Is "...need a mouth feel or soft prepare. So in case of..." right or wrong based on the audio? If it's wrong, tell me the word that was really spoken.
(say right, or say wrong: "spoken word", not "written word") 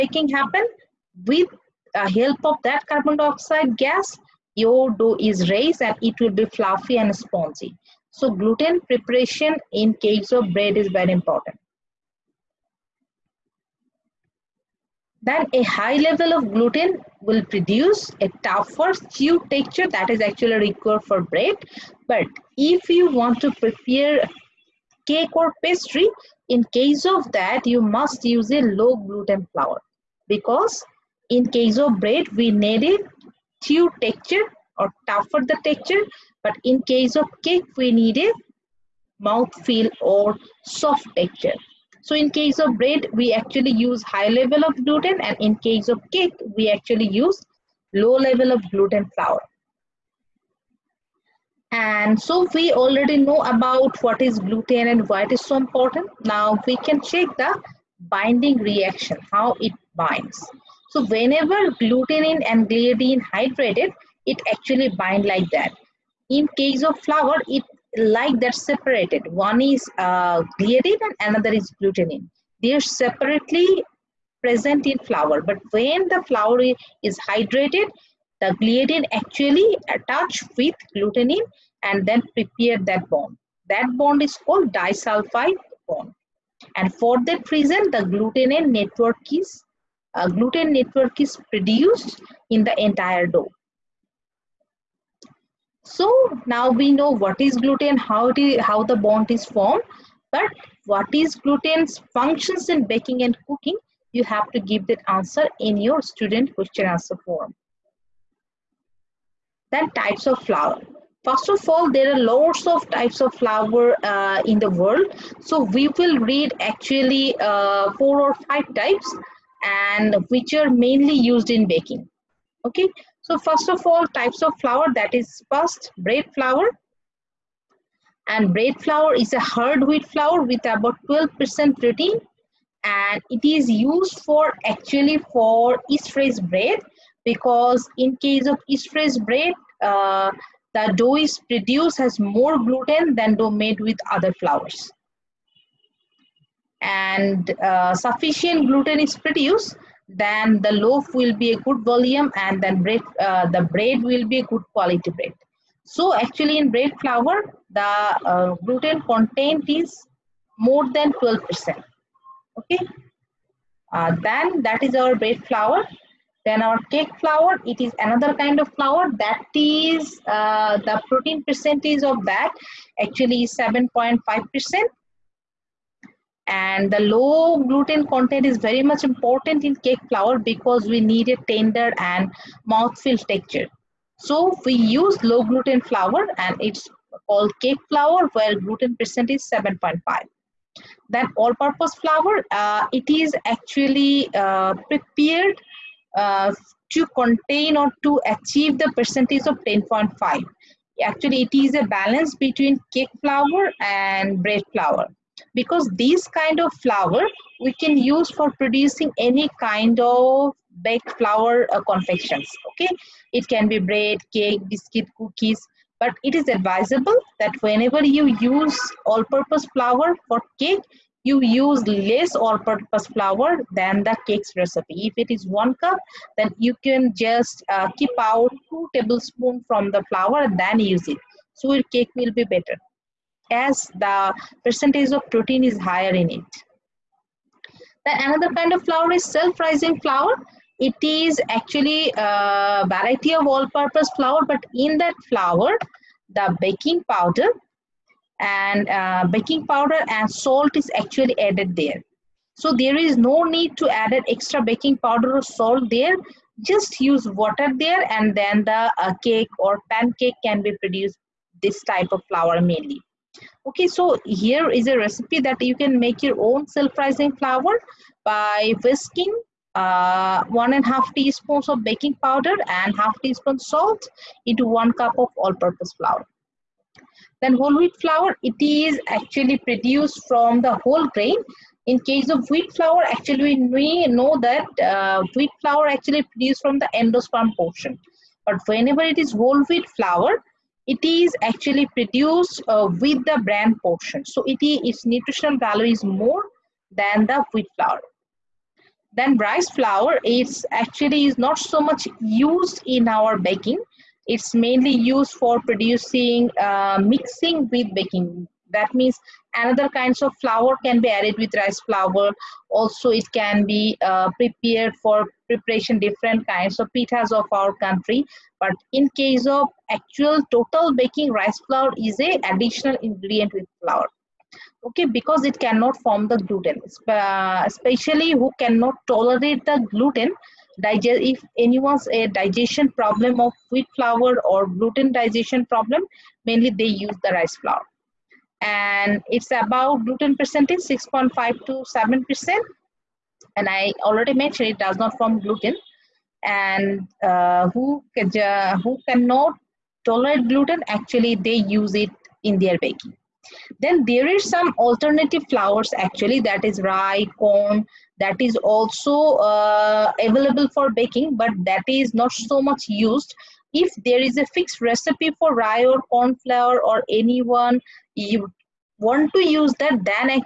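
wrong: "texture", not "prepare".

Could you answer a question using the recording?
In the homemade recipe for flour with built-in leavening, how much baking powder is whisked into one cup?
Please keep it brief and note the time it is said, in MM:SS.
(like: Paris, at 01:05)
1.5 teaspoons, at 04:30.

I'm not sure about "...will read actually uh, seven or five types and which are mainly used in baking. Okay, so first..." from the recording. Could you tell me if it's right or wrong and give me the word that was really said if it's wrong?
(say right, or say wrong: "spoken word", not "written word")
wrong: "four", not "seven".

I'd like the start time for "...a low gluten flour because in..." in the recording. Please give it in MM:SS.
00:28.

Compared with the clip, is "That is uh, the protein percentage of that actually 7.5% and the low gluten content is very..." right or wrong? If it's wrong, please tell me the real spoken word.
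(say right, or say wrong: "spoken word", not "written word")
right.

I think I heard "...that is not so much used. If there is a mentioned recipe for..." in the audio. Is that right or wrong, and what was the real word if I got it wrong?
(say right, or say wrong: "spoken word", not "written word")
wrong: "fixed", not "mentioned".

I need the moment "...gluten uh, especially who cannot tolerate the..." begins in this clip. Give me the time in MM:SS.
05:26.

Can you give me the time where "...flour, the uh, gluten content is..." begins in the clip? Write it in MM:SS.
02:36.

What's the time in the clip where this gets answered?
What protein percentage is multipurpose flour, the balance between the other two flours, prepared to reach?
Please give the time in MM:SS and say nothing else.
03:19.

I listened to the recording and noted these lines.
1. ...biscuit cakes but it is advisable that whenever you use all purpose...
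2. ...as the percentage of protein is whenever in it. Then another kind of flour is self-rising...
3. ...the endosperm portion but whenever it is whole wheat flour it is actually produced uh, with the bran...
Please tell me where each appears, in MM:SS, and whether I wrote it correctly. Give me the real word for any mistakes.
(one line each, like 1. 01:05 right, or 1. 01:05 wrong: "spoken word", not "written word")
1. 03:34 wrong: "cookies", not "cakes"
2. 03:53 wrong: "higher", not "whenever"
3. 04:46 right.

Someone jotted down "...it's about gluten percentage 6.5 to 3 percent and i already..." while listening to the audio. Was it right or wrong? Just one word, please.
wrong.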